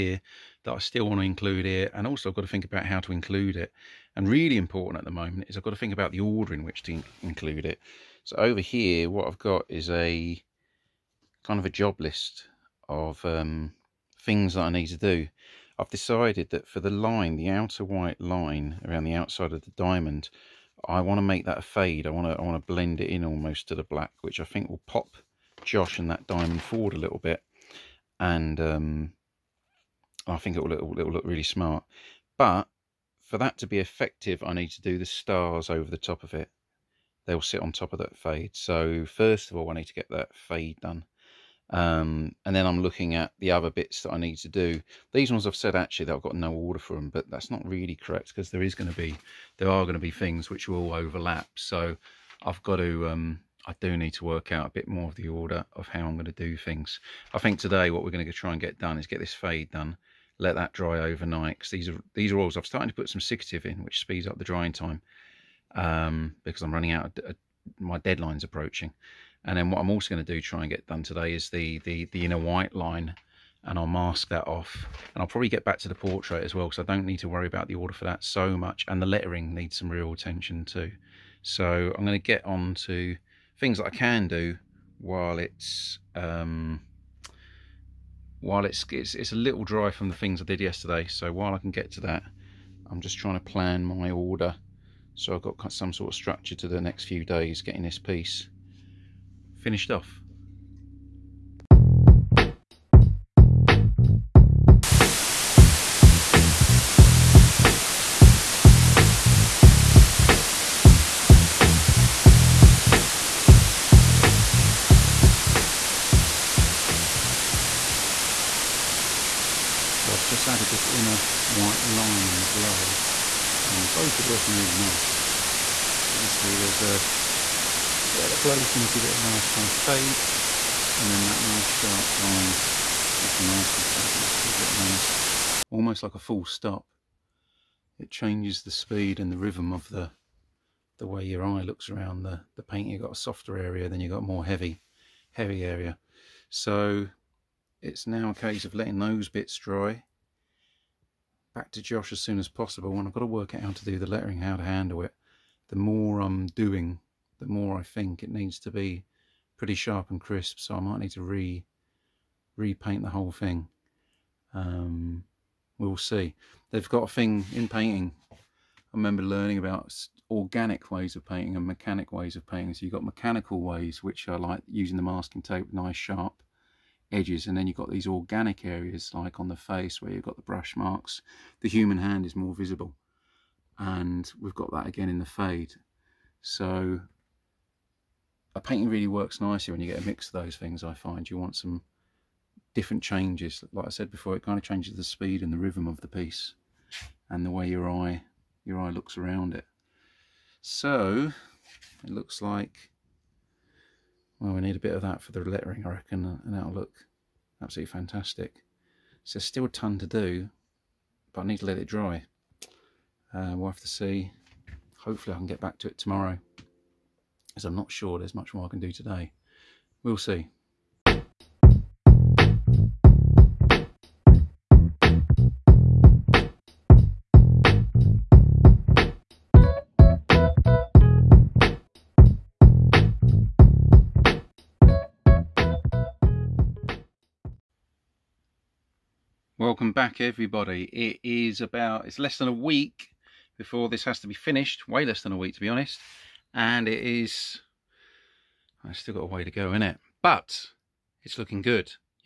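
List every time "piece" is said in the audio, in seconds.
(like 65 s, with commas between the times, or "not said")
97 s, 196 s.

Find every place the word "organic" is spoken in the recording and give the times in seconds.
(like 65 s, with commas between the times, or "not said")
170 s, 178 s.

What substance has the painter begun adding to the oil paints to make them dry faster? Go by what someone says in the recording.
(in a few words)
Siccative.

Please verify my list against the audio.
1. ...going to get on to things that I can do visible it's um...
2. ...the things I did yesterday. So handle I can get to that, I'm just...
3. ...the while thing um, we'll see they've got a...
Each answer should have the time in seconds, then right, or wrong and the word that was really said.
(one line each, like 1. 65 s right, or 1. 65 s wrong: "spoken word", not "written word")
1. 82 s wrong: "while", not "visible"
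2. 90 s wrong: "while", not "handle"
3. 163 s wrong: "whole", not "while".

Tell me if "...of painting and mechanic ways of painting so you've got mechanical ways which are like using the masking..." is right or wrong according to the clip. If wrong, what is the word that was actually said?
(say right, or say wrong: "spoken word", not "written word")
right.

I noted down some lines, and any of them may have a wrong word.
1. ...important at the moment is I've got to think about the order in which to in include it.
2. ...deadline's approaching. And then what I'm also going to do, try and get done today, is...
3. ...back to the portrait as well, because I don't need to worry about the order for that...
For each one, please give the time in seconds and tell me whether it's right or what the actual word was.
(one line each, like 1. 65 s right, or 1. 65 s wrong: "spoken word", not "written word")
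1. 4 s right
2. 67 s right
3. 75 s right.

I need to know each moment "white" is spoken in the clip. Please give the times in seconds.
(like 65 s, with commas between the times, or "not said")
17 s, 72 s, 121 s.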